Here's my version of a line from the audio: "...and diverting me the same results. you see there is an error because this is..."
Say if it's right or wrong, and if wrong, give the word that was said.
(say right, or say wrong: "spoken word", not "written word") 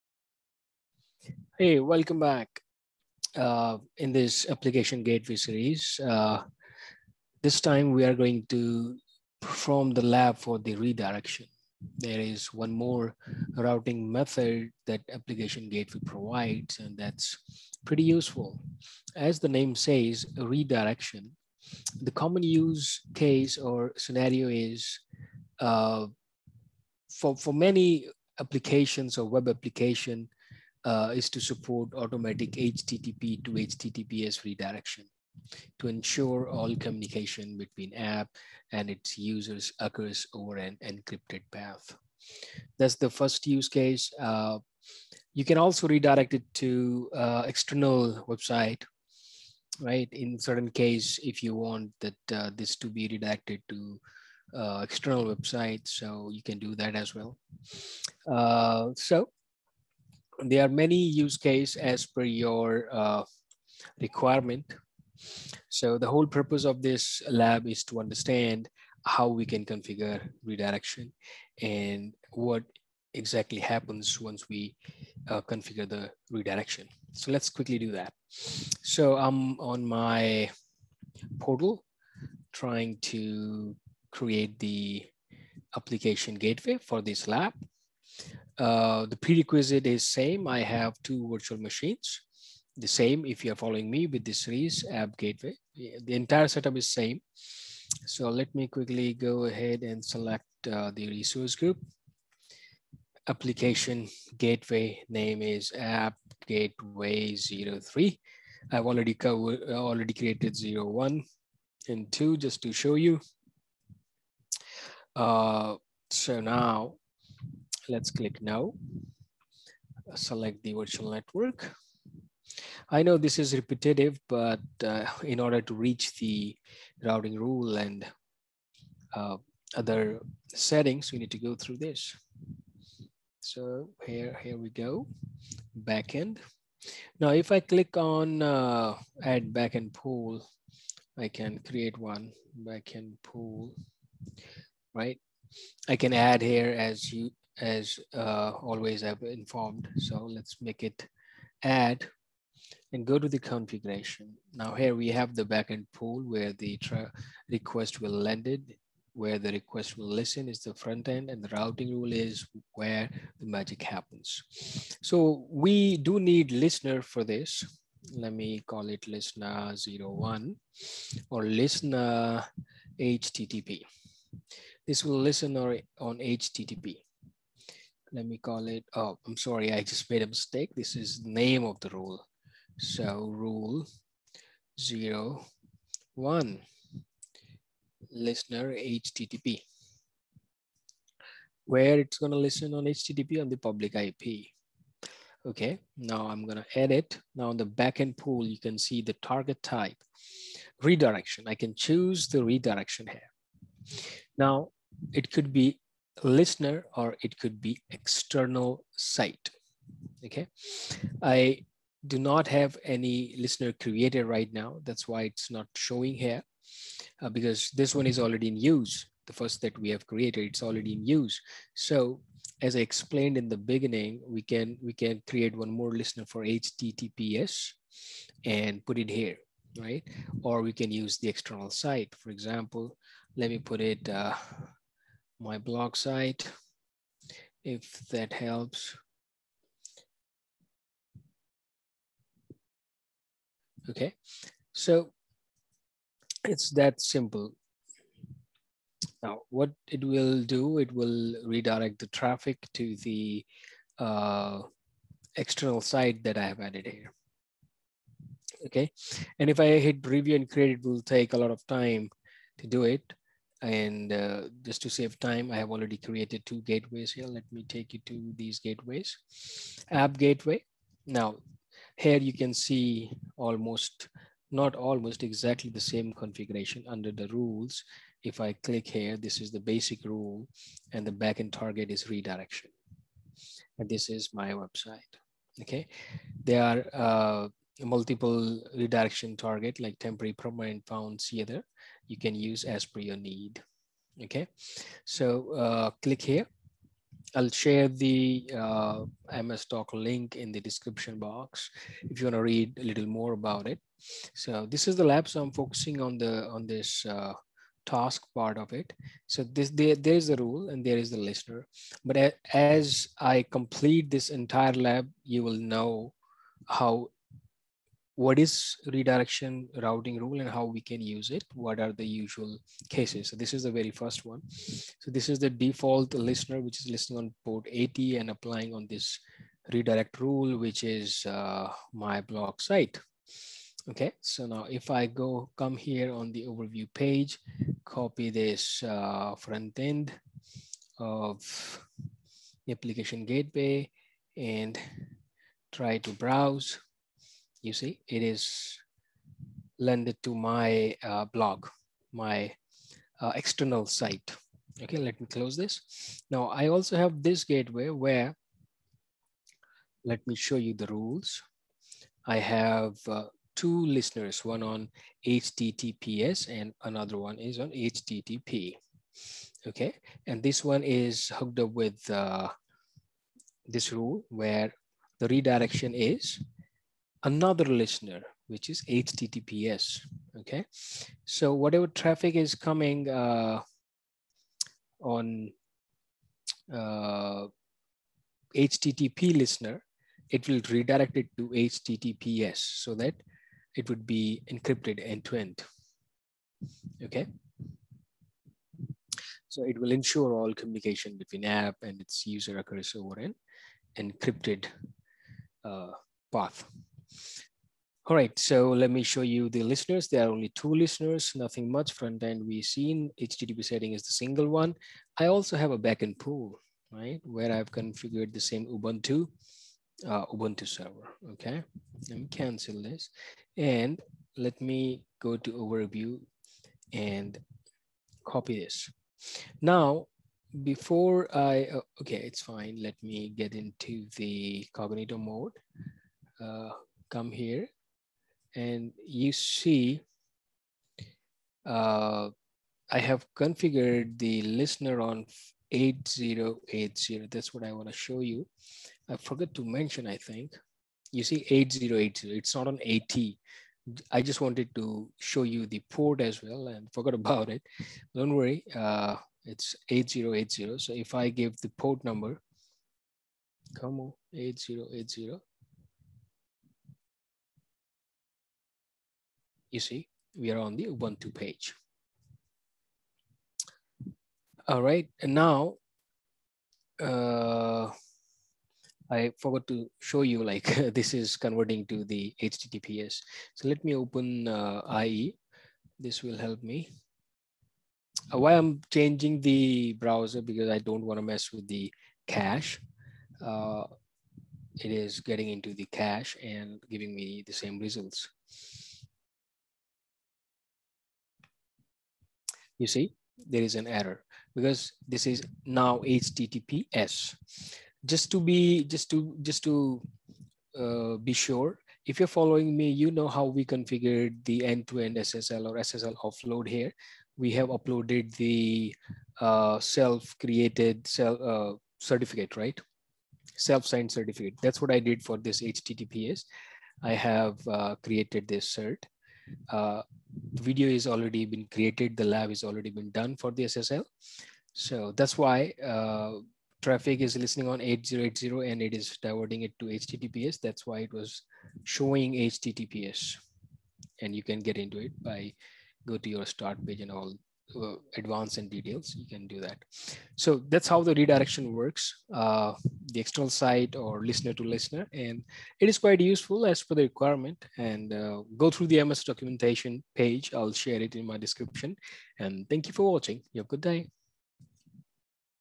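wrong: "giving", not "diverting".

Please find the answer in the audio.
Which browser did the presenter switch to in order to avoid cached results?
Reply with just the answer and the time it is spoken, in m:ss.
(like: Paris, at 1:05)
IE, at 8:05.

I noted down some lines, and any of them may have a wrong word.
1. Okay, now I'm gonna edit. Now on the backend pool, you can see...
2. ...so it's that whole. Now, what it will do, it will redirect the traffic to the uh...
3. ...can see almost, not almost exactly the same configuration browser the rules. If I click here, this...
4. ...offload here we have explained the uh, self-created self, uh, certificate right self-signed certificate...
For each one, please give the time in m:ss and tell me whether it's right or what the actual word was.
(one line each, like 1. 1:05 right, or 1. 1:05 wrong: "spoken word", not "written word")
1. 3:15 right
2. 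4:04 wrong: "simple", not "whole"
3. 4:32 wrong: "under", not "browser"
4. 8:36 wrong: "uploaded", not "explained".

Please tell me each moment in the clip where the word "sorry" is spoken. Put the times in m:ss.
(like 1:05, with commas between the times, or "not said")
2:59.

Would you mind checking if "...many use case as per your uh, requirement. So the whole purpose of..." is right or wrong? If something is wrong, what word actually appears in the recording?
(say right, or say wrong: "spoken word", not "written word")
right.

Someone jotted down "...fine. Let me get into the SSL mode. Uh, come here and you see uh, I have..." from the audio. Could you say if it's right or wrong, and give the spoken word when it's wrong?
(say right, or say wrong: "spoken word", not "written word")
wrong: "Cognito", not "SSL".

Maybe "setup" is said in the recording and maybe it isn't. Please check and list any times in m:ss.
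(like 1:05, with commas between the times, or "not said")
1:36.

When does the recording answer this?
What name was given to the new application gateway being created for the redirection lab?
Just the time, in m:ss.
1:45.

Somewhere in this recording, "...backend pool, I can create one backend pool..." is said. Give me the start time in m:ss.
2:19.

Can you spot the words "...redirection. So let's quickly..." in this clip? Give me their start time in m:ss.
1:16.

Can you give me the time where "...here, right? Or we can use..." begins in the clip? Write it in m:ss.
3:49.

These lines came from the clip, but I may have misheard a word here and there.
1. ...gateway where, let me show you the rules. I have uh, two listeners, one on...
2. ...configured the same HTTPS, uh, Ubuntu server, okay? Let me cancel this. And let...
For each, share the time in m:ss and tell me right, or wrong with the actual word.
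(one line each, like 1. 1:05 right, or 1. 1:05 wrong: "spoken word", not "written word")
1. 5:57 right
2. 6:57 wrong: "Ubuntu", not "HTTPS".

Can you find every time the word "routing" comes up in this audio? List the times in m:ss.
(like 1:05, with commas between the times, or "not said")
0:13, 2:07, 2:41, 5:19.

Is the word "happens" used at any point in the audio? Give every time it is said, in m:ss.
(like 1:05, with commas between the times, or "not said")
1:13, 2:43.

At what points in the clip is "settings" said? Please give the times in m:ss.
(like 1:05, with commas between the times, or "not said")
2:10, 6:53.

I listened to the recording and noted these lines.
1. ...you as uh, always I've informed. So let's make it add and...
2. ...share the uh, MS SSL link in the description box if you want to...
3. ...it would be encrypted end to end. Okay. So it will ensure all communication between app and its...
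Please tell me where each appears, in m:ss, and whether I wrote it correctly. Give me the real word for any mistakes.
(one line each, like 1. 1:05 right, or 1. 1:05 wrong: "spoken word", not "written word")
1. 2:27 right
2. 4:57 wrong: "Doc", not "SSL"
3. 6:33 right.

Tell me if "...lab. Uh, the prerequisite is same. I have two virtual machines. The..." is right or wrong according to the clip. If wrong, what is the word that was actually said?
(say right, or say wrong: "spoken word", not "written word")
right.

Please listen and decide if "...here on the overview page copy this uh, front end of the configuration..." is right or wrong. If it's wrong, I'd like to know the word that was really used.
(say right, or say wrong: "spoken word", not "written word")
wrong: "application", not "configuration".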